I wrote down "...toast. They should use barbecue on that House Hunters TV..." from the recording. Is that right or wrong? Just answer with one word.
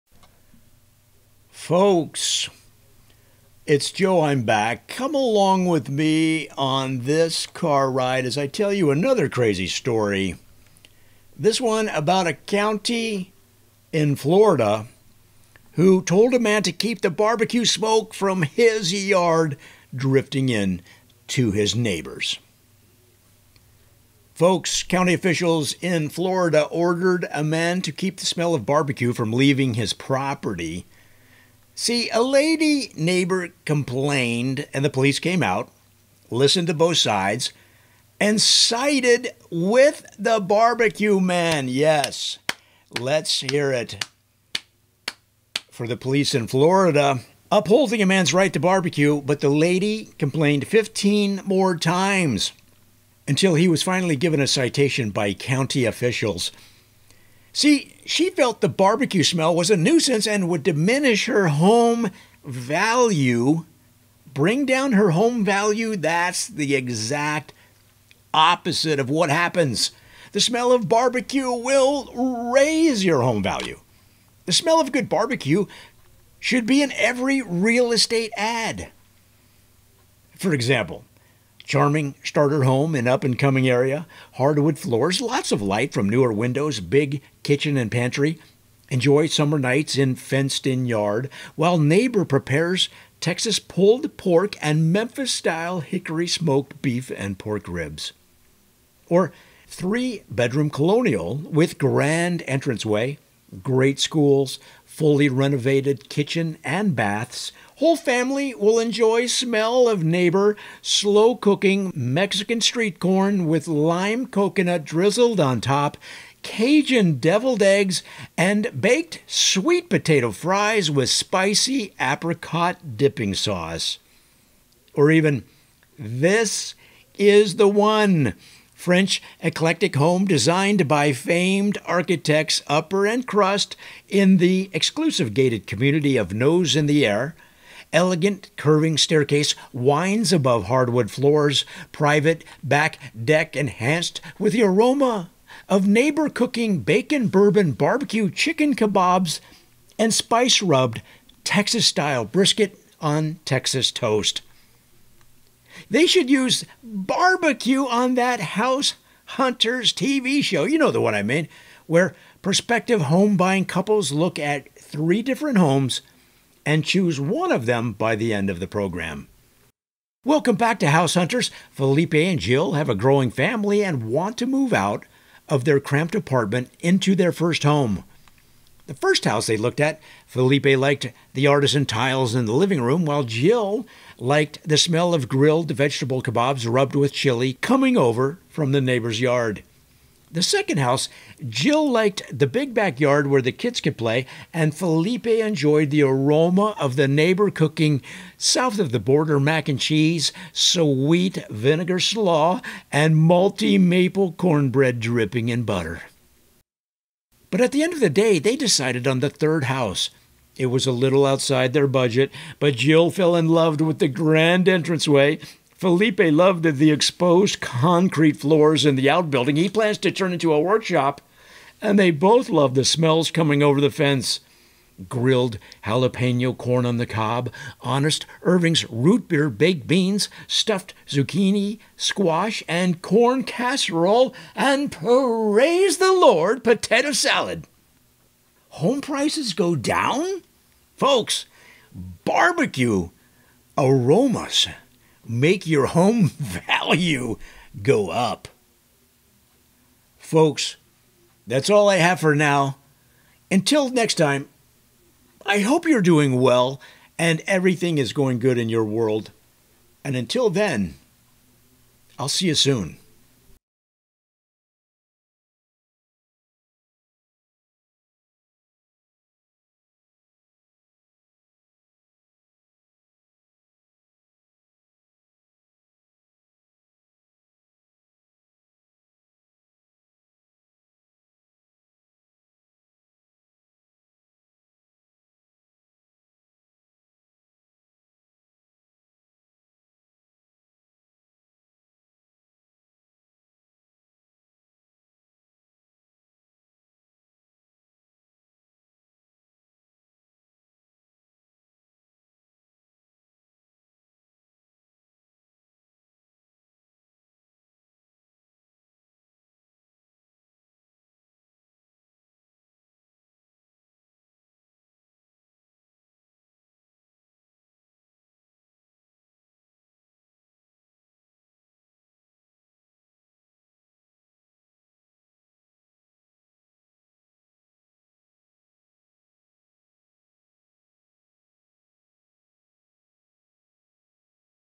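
right.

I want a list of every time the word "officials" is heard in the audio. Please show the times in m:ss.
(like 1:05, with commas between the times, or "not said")
0:25, 0:55.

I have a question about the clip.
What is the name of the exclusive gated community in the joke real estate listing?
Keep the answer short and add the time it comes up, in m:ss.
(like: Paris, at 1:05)
Nose in the Air, at 2:16.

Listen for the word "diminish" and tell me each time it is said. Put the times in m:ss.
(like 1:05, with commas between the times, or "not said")
1:00.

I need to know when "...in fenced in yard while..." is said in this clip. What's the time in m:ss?
1:29.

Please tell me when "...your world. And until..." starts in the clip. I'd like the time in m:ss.
4:18.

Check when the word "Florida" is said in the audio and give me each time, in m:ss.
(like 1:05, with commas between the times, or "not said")
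0:14, 0:26, 0:46.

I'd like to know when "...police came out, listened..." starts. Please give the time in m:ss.
0:34.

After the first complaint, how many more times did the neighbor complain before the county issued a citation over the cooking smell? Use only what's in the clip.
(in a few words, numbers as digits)
15.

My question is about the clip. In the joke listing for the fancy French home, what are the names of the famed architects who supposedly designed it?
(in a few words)
Upper and Crust.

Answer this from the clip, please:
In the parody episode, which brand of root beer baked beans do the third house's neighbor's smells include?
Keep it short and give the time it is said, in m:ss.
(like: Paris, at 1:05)
Honest Irving's, at 3:47.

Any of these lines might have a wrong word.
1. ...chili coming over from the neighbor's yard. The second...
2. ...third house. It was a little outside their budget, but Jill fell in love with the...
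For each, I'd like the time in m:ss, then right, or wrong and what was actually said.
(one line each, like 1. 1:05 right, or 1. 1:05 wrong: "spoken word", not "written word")
1. 3:07 right
2. 3:29 right.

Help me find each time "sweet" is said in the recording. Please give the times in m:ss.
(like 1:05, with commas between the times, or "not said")
1:59, 3:20.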